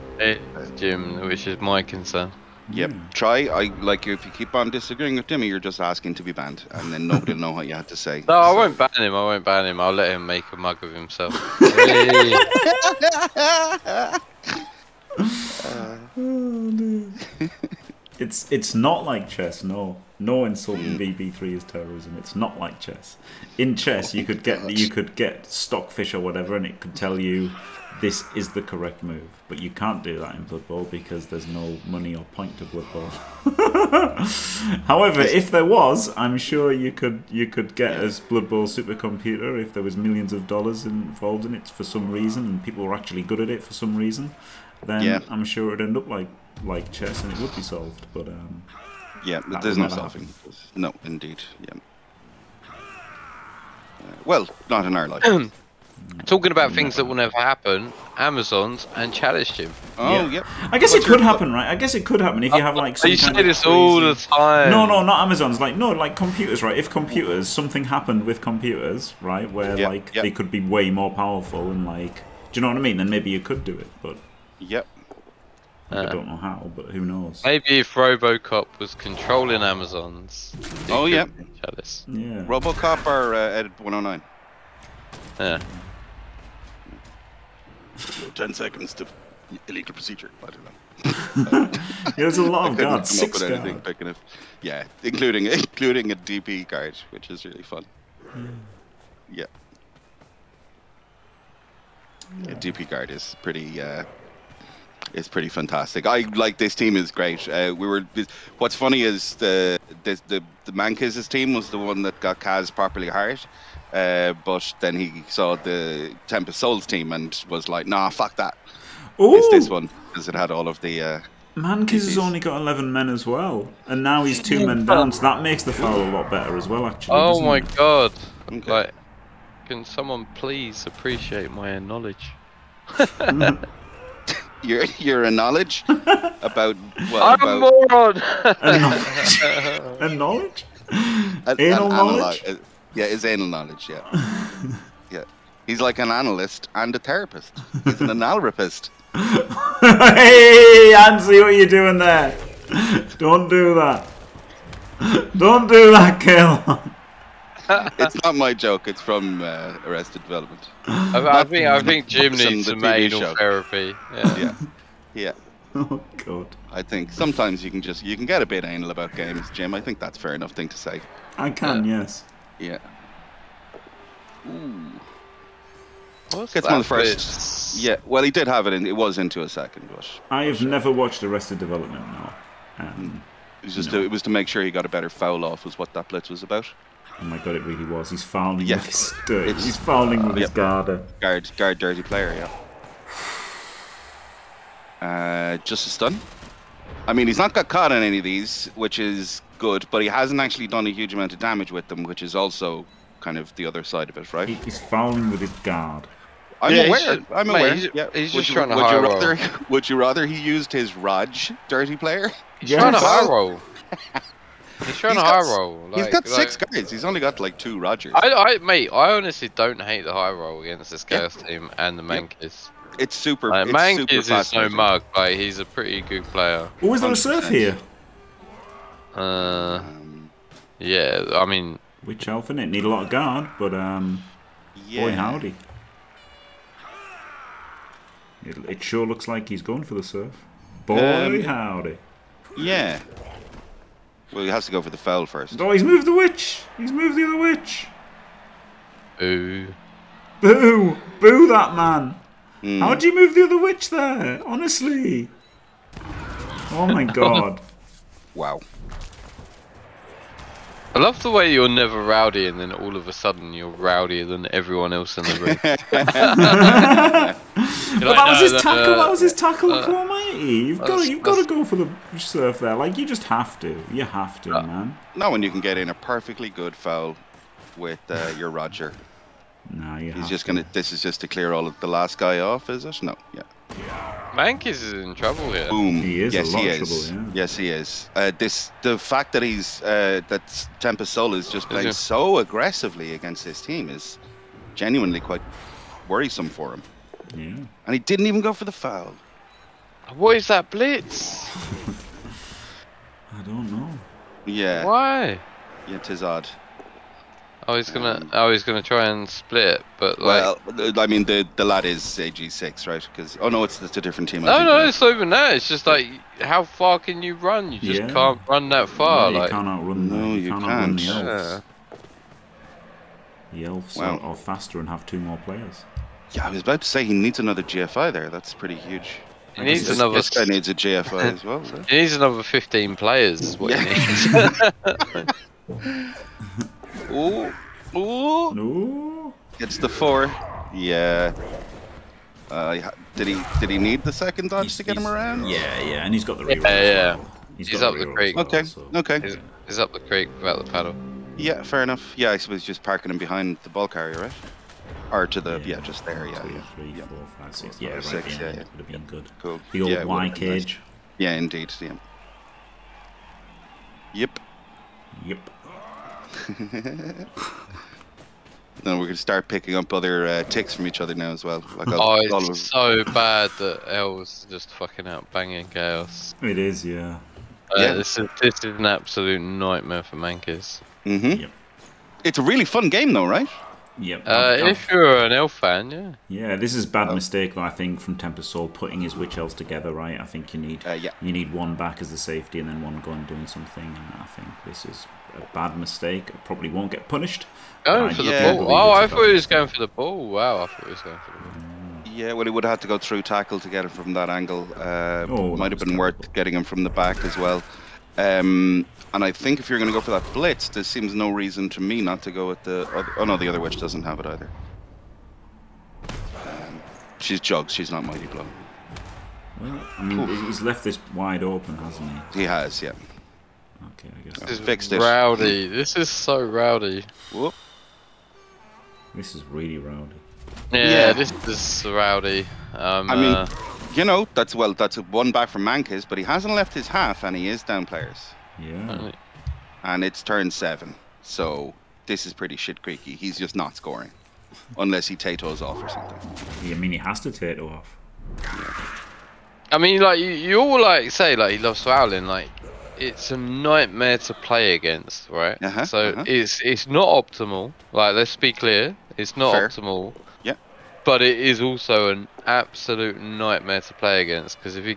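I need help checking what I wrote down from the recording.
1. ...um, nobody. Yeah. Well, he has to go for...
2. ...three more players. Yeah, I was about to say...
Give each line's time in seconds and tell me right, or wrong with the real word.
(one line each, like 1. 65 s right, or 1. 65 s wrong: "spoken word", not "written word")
1. 241 s wrong: "howdy", not "nobody"
2. 325 s wrong: "two", not "three".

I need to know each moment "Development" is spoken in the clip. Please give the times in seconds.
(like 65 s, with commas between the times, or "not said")
160 s, 181 s.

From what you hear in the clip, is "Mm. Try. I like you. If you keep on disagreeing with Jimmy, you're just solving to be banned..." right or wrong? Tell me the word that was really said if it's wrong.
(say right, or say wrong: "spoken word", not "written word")
wrong: "asking", not "solving".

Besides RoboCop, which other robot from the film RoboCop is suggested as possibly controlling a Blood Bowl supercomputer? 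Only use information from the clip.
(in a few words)
Ed 109.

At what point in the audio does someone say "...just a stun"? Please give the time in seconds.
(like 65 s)
195 s.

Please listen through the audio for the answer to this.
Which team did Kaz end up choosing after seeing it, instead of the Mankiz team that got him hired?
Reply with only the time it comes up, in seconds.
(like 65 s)
116 s.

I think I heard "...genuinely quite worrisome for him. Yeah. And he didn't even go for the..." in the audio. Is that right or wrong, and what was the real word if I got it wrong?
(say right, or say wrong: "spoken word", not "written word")
right.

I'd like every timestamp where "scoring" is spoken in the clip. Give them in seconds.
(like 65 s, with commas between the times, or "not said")
443 s.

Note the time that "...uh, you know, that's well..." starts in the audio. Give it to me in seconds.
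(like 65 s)
433 s.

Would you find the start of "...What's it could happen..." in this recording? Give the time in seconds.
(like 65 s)
60 s.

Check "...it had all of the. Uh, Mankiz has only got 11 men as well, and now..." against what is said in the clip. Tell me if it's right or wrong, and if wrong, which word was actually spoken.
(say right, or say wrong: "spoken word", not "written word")
right.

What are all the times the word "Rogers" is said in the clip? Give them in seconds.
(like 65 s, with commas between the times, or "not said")
217 s, 278 s.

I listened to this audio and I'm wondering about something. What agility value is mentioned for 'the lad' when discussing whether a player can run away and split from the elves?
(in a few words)
AG6.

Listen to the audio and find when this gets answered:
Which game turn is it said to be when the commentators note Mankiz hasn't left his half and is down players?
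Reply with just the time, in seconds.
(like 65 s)
440 s.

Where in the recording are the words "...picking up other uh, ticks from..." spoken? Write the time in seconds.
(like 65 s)
369 s.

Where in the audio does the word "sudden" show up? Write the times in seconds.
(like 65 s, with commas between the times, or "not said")
263 s.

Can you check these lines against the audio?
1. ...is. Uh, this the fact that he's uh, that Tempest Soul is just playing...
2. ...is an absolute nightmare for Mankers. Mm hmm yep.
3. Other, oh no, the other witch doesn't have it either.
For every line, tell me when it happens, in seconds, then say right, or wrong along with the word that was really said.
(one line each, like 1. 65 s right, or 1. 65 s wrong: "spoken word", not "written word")
1. 287 s right
2. 378 s right
3. 412 s right.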